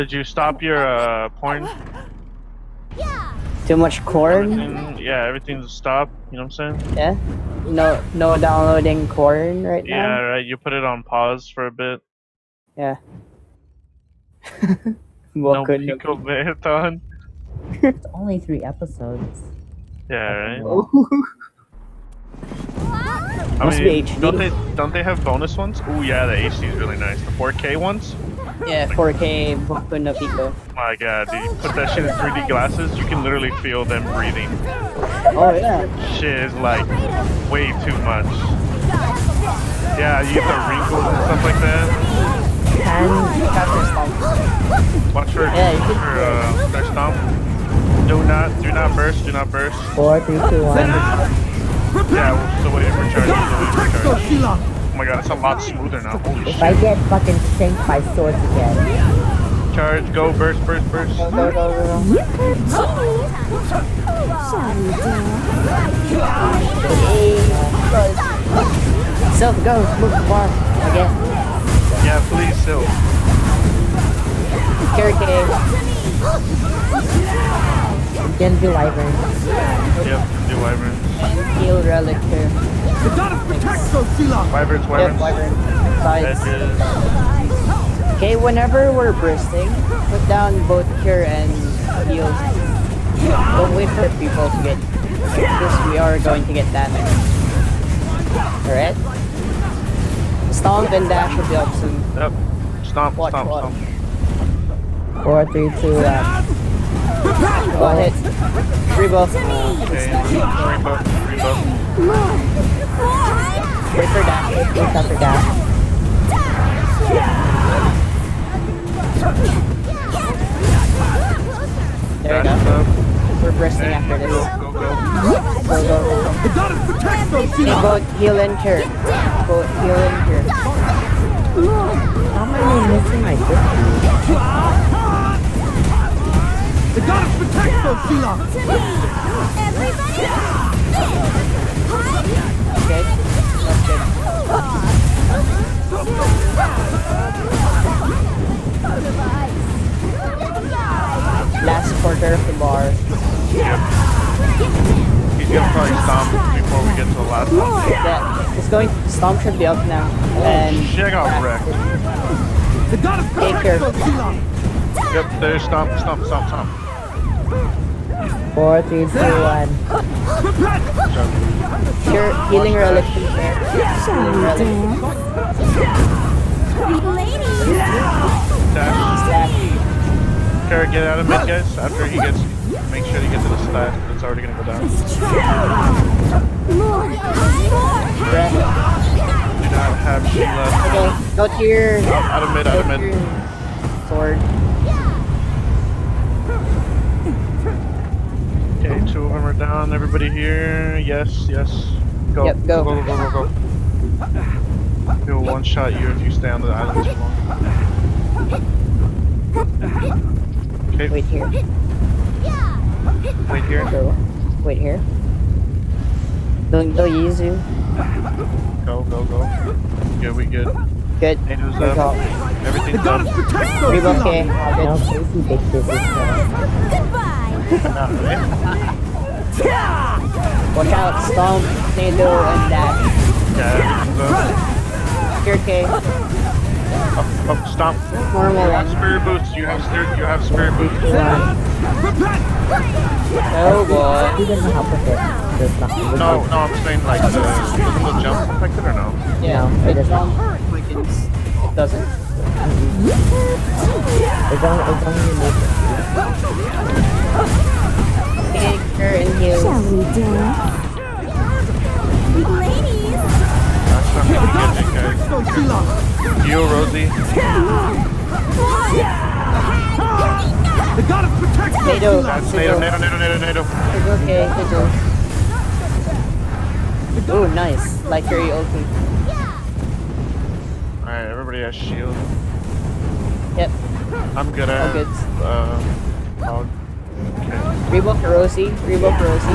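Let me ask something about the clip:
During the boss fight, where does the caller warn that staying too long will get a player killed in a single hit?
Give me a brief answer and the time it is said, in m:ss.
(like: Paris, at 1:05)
the island, at 3:26.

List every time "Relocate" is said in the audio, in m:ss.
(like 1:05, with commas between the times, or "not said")
3:43.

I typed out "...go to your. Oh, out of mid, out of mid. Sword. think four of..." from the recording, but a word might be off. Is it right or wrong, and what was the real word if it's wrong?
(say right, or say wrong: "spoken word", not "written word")
wrong: "two", not "four".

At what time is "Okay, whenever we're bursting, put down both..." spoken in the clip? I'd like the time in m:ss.
1:28.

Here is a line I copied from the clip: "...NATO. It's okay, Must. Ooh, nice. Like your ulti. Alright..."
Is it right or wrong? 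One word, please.
wrong.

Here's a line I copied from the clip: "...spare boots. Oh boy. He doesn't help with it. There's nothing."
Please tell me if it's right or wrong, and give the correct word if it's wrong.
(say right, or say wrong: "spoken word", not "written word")
right.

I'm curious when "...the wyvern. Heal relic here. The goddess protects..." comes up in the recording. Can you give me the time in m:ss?
1:20.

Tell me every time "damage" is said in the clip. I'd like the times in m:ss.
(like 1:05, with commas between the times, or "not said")
1:36.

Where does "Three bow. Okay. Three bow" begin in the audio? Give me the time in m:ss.
1:48.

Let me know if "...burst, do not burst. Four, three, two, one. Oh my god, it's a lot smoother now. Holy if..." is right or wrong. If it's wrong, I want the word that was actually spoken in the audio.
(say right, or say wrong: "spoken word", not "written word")
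right.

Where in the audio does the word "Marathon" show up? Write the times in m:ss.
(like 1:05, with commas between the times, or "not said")
0:16.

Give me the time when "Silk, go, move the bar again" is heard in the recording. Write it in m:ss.
1:09.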